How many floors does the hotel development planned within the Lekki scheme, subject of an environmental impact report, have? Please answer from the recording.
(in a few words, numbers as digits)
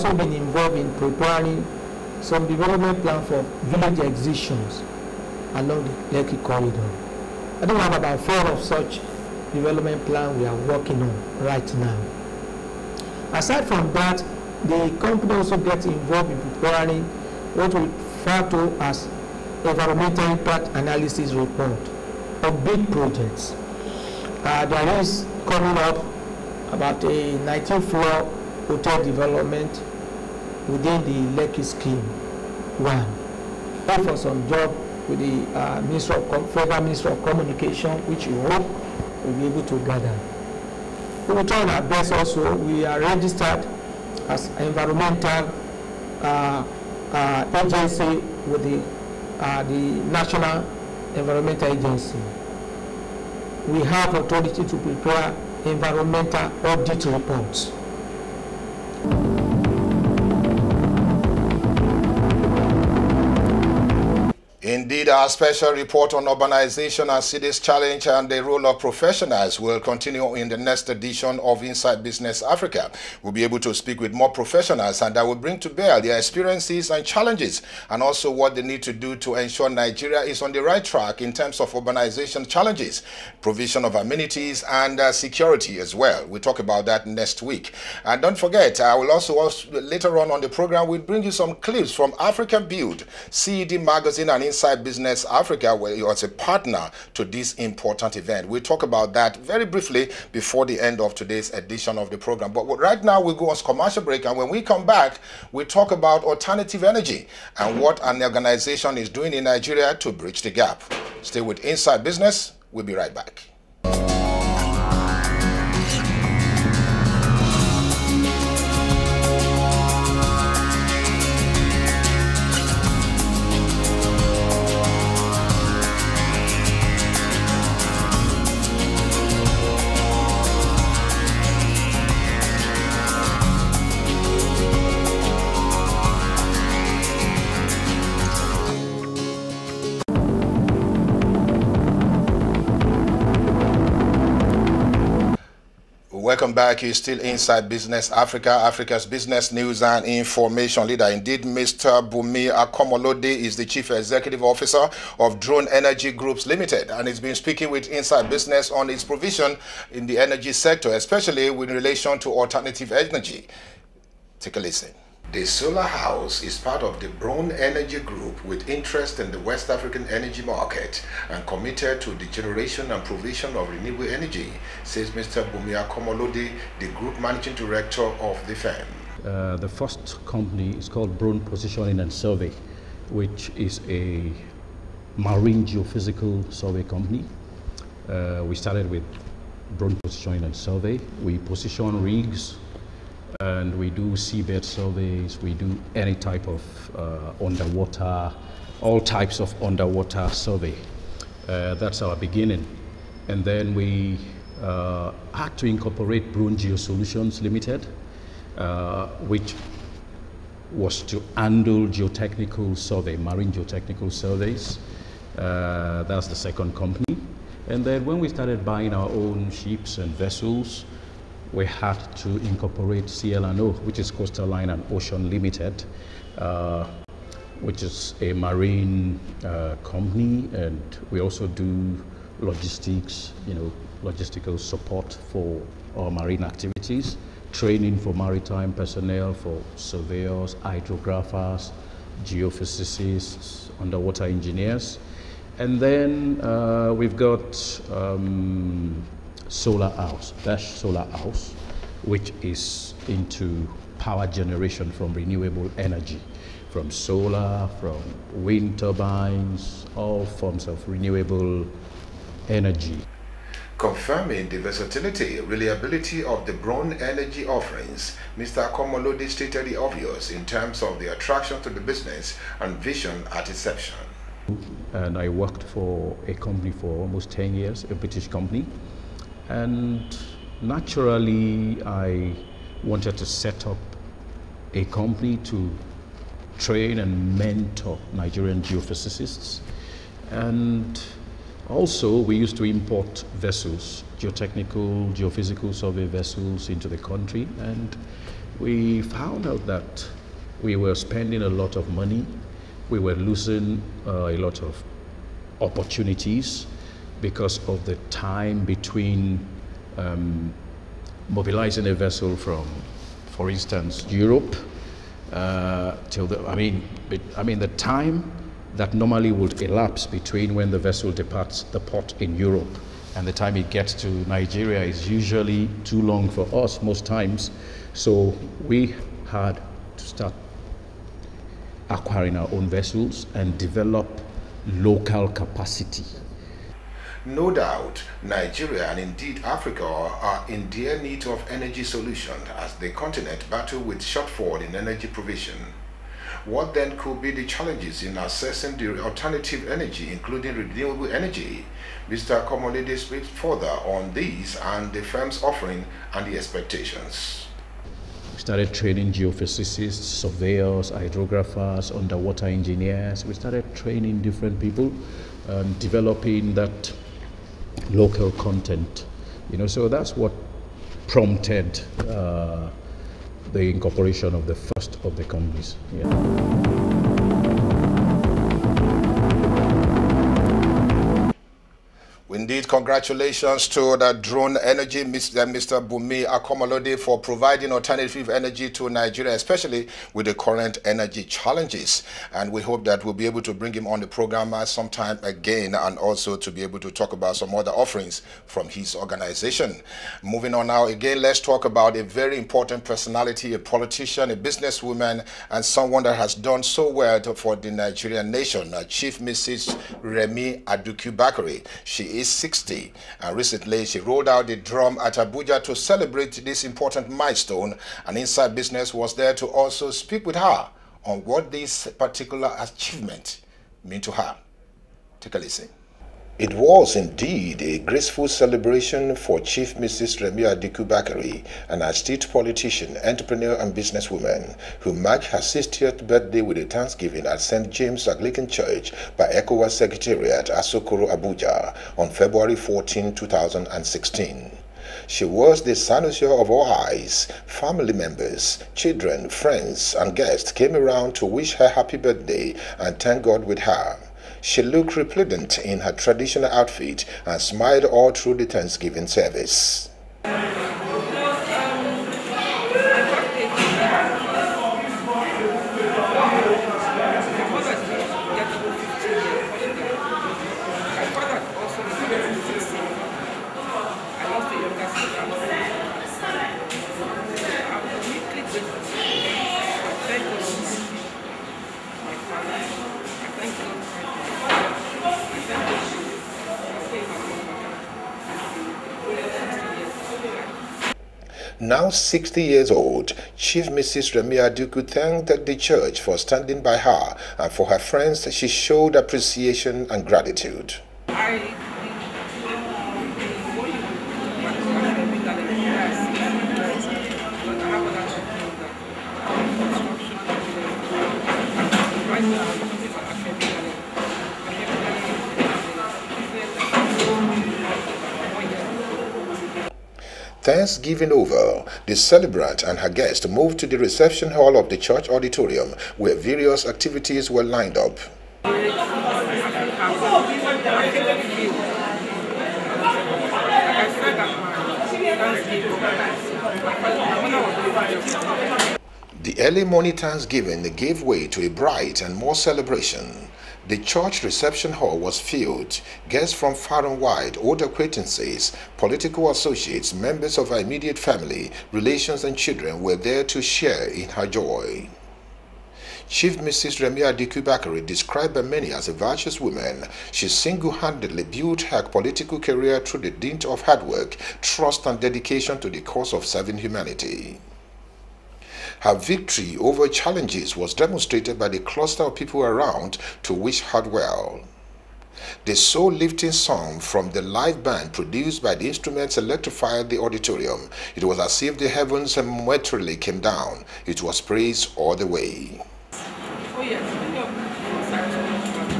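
19.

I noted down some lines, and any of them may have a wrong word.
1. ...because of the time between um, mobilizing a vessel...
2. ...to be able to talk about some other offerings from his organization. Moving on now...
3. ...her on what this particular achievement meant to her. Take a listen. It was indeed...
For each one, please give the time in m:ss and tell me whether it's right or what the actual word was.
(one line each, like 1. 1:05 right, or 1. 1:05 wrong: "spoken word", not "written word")
1. 5:07 right
2. 6:36 right
3. 7:00 right.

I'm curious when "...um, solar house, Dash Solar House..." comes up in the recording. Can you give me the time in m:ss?
4:07.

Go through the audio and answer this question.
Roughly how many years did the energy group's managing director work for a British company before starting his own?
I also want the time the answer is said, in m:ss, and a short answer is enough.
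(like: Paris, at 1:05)
10, at 4:37.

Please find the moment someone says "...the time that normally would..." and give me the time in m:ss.
5:17.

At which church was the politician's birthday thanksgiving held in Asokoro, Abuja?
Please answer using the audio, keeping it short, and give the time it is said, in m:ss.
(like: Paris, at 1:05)
St. James Anglican Church, at 7:17.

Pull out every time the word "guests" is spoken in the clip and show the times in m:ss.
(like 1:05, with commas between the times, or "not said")
7:30, 8:42, 9:06.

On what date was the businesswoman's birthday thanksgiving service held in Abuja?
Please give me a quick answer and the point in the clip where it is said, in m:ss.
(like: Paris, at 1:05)
February 14, 2016, at 7:22.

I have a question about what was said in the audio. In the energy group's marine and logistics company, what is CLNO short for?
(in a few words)
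Coastal Line and Ocean Limited.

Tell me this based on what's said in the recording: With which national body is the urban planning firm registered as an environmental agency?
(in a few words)
National Environmental Agency.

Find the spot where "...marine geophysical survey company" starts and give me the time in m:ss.
3:05.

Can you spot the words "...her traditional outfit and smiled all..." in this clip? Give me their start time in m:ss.
7:35.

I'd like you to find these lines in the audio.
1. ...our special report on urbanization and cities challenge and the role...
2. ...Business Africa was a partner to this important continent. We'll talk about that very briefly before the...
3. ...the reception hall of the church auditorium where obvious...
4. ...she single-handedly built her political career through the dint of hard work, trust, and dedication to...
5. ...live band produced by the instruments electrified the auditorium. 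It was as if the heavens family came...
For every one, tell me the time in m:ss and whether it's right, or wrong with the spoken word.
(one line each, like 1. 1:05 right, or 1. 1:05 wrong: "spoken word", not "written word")
1. 1:05 right
2. 1:34 wrong: "event", not "continent"
3. 8:43 wrong: "various", not "obvious"
4. 9:20 right
5. 9:37 wrong: "momentarily", not "family".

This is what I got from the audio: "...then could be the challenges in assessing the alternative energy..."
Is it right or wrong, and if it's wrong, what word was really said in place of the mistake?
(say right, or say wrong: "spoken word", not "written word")
right.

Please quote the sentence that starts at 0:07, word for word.
I think we have about four of such development plan we are working on right now.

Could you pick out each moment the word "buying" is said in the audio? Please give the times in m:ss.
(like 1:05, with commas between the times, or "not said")
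3:38.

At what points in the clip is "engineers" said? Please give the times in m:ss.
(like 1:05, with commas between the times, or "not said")
4:04, 6:02.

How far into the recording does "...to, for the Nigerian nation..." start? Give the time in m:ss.
6:47.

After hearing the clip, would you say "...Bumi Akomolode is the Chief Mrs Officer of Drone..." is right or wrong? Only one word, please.
wrong.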